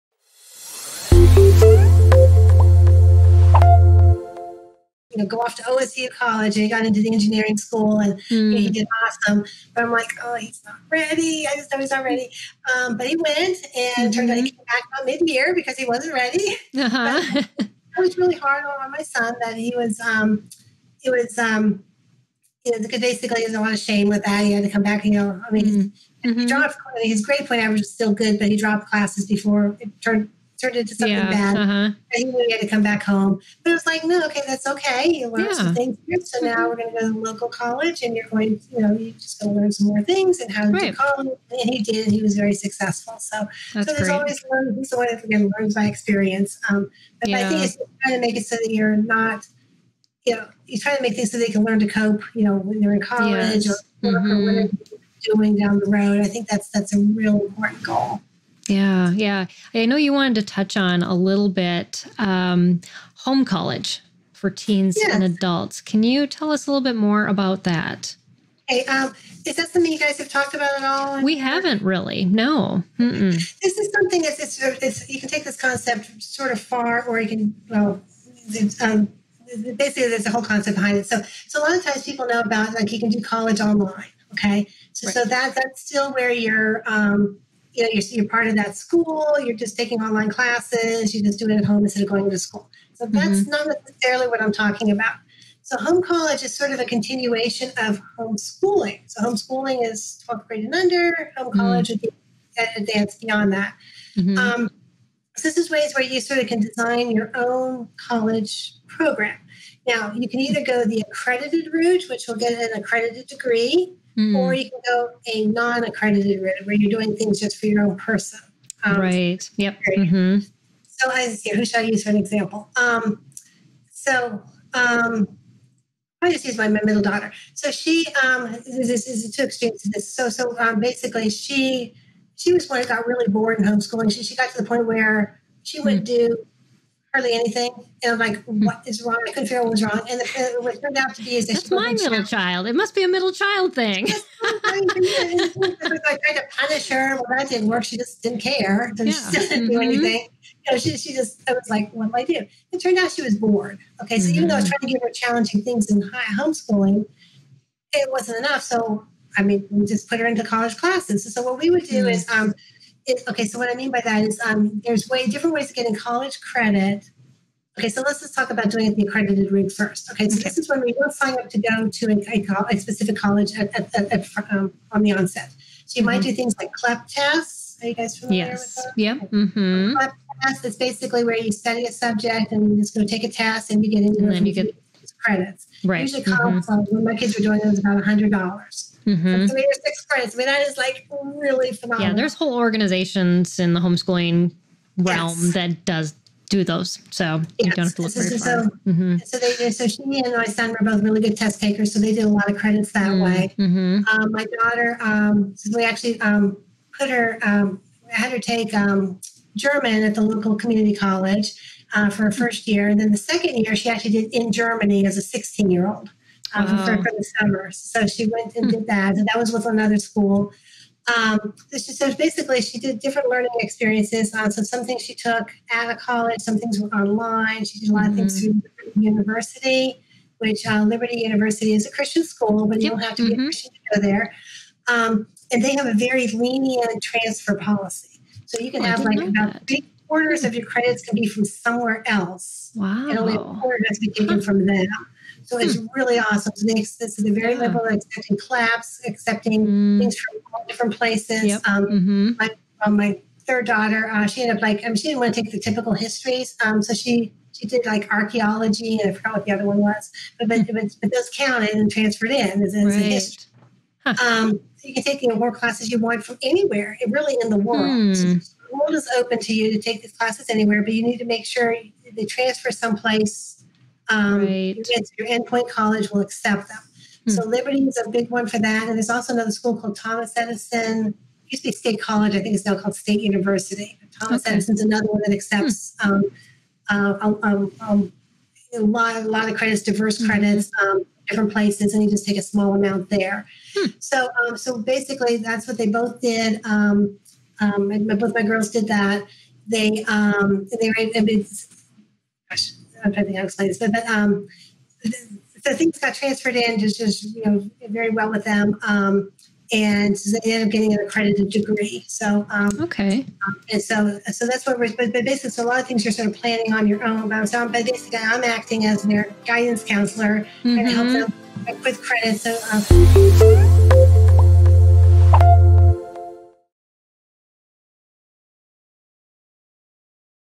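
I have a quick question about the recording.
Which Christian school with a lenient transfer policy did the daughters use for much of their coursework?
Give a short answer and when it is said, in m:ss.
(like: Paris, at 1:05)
Liberty University, at 3:50.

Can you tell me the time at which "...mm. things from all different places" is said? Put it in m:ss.
4:09.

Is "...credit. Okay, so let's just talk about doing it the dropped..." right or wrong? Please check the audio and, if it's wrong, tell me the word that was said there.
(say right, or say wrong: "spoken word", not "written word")
wrong: "accredited", not "dropped".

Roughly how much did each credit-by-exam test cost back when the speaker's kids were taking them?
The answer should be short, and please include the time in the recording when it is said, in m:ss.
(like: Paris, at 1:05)
$100, at 3:08.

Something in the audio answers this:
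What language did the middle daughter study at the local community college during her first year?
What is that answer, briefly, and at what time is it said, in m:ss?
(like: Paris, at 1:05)
German, at 3:29.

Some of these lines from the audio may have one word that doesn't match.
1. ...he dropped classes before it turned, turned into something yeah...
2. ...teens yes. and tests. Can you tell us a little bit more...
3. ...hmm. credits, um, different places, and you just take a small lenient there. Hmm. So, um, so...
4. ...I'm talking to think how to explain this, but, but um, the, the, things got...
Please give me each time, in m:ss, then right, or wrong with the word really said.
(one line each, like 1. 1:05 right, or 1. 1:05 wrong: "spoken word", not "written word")
1. 0:28 right
2. 1:04 wrong: "adults", not "tests"
3. 4:50 wrong: "amount", not "lenient"
4. 5:03 wrong: "trying", not "talking".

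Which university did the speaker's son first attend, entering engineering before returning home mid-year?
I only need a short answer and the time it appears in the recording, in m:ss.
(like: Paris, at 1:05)
OSU, at 0:05.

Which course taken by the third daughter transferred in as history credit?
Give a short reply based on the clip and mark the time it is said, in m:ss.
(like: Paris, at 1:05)
Archaeology, at 4:18.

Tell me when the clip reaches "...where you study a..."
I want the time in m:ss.
3:01.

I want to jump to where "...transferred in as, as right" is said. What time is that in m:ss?
4:21.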